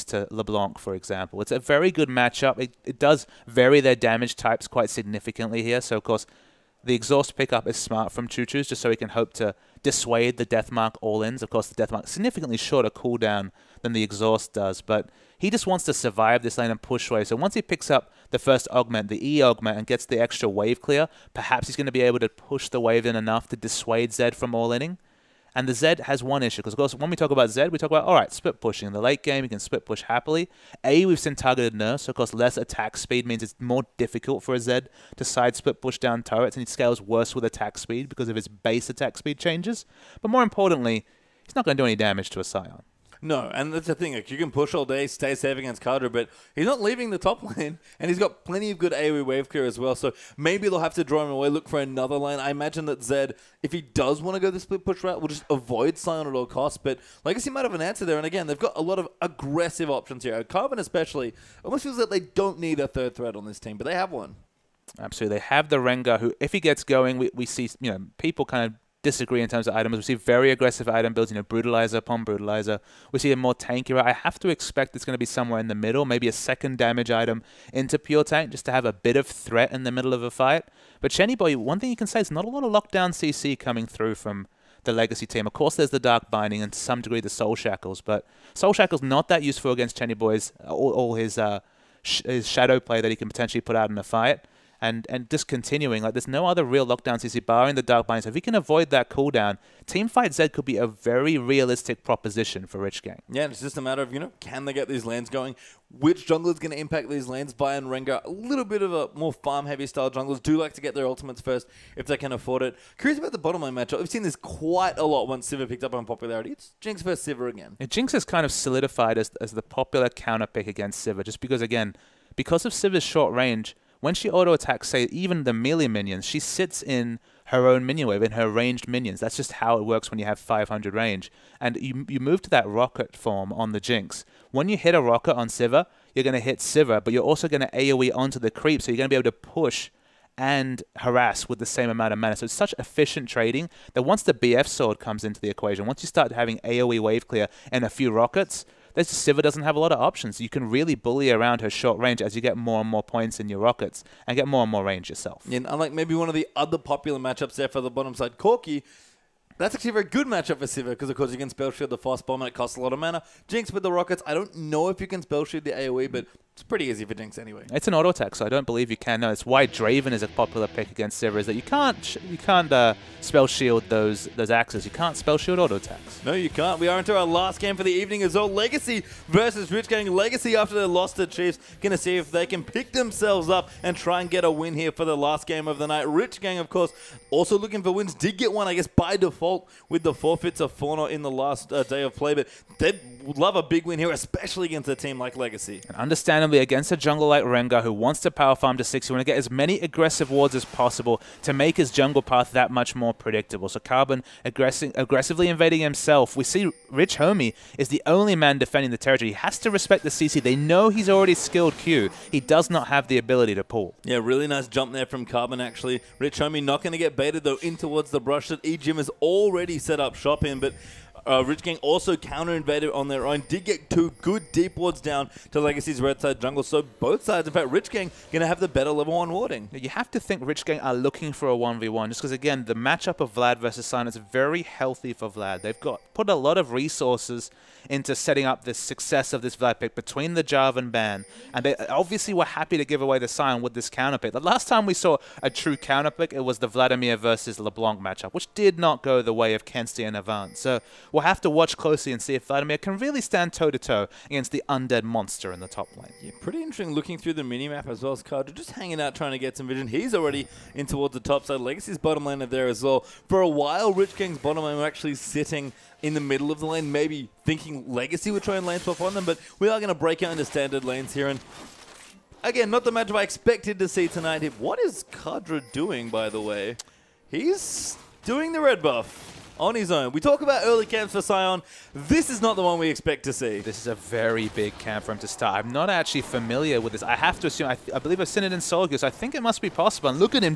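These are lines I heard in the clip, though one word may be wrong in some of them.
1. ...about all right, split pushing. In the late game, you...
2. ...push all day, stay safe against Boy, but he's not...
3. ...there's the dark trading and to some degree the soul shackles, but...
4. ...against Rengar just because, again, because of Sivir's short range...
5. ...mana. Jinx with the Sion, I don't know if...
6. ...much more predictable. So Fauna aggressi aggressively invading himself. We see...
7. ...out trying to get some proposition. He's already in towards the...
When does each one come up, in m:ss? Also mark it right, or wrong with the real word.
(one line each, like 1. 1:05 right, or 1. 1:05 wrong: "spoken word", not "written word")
1. 0:27 right
2. 0:44 wrong: "Carter", not "Boy"
3. 1:25 wrong: "binding", not "trading"
4. 2:00 wrong: "Sivir", not "Rengar"
5. 2:42 wrong: "Rockets", not "Sion"
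6. 3:22 wrong: "Carbon", not "Fauna"
7. 4:18 wrong: "vision", not "proposition".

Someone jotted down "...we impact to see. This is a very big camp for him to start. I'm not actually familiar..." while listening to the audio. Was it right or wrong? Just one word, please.
wrong.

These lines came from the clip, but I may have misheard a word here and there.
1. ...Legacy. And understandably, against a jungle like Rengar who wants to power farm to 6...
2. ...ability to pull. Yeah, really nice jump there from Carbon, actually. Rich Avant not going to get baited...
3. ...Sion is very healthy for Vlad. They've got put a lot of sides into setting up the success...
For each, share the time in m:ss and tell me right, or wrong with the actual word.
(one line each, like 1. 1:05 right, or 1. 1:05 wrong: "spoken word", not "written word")
1. 3:15 right
2. 3:33 wrong: "Homie", not "Avant"
3. 3:53 wrong: "resources", not "sides".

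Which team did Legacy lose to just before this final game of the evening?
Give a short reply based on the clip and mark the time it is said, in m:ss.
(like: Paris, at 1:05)
Chiefs, at 3:01.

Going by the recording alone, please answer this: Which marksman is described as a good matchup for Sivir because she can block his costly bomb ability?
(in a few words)
Corki.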